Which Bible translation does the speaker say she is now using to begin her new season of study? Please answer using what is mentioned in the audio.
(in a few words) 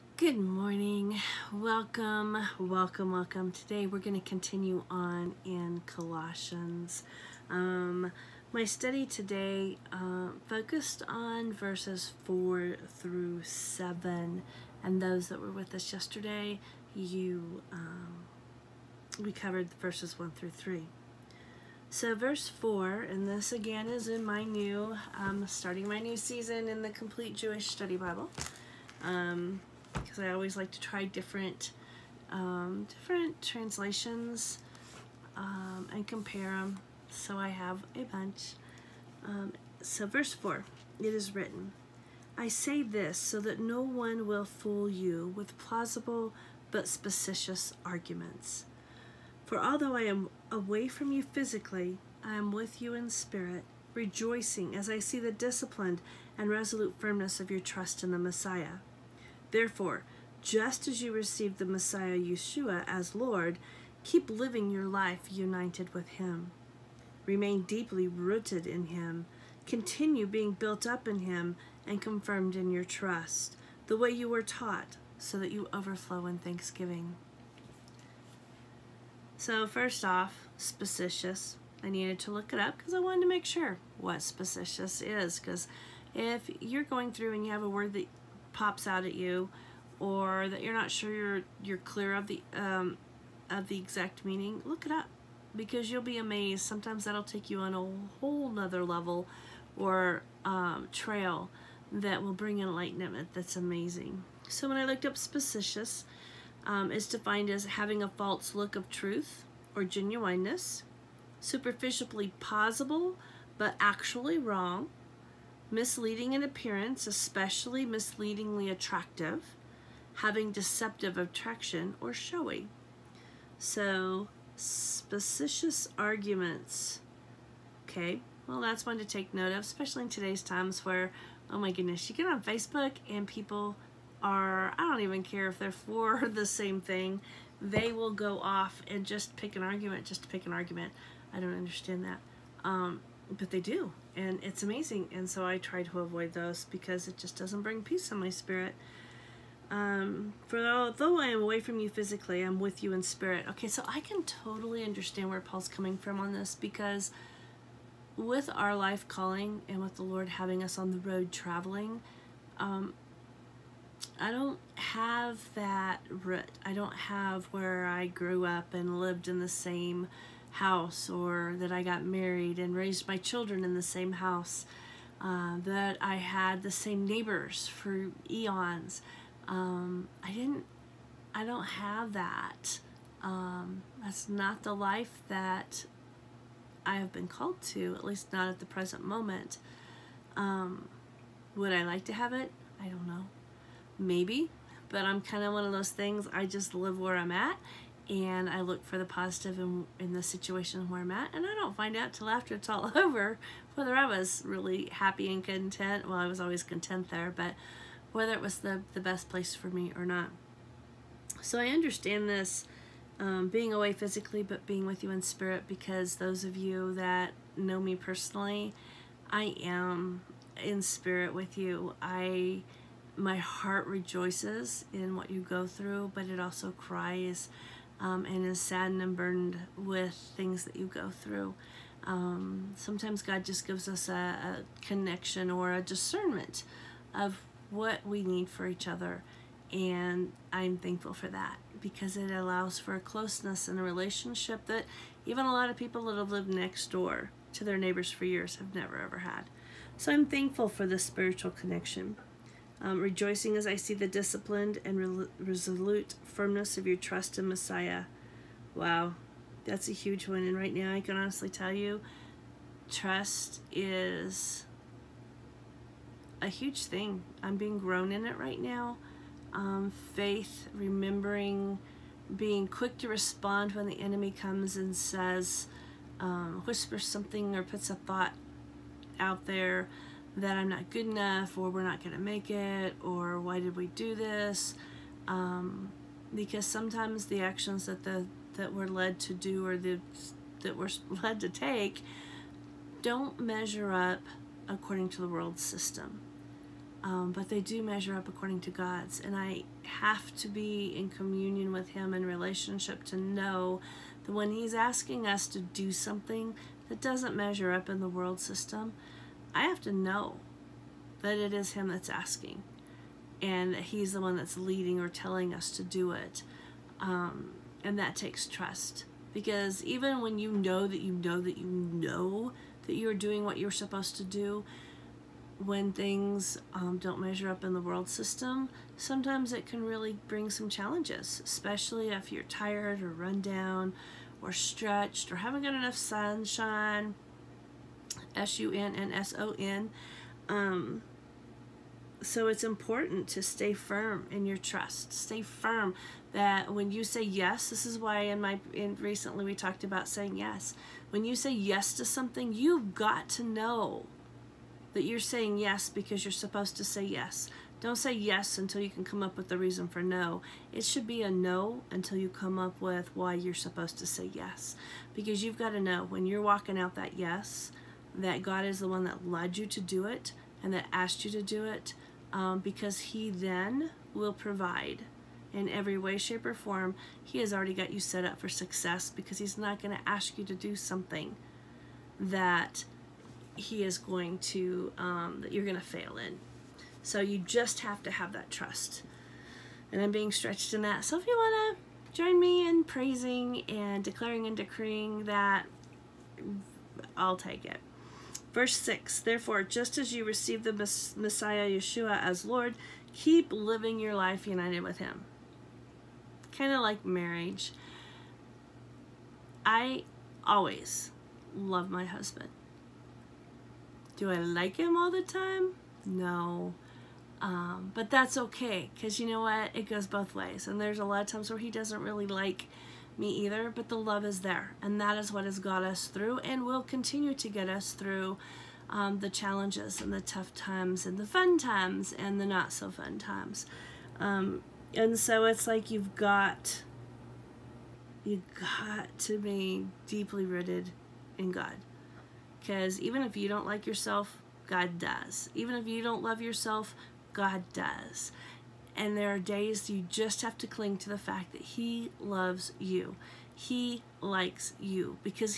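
Complete Jewish Study Bible.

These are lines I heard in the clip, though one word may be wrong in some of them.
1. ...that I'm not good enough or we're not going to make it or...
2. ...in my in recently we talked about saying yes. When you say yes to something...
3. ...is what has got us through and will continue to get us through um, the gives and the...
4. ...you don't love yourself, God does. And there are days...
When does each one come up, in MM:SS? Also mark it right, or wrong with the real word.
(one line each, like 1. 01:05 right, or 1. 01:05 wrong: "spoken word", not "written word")
1. 04:40 right
2. 05:48 right
3. 07:05 wrong: "challenges", not "gives"
4. 07:25 right.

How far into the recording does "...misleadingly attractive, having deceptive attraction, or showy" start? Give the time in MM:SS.
01:57.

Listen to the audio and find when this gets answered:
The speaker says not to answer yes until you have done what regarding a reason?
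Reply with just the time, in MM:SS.
05:59.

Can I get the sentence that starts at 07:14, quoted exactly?
Um, and so it's like you've got you got to be deeply rooted in God.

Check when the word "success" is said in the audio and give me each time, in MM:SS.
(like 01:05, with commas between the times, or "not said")
06:18.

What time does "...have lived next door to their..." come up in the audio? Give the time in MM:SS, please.
04:06.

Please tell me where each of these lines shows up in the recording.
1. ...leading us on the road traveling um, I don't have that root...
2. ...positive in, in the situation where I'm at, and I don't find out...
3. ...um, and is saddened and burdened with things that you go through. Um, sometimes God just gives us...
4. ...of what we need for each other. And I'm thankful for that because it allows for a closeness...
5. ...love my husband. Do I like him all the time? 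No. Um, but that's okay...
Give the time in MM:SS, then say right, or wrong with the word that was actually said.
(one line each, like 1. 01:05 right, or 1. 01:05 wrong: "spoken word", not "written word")
1. 02:40 wrong: "having", not "leading"
2. 03:19 right
3. 03:47 right
4. 03:57 right
5. 06:51 right.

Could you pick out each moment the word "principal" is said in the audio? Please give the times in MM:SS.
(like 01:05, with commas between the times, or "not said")
not said.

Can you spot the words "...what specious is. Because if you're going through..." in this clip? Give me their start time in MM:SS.
01:23.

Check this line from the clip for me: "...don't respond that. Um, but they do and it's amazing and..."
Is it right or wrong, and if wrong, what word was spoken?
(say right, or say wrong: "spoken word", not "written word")
wrong: "understand", not "respond".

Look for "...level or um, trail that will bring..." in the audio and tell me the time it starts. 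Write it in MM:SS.
01:38.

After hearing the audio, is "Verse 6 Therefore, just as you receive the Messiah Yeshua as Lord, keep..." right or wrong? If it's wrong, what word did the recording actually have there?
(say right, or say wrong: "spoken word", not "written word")
right.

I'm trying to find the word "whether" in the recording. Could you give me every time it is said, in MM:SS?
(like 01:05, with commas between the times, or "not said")
03:23, 03:28.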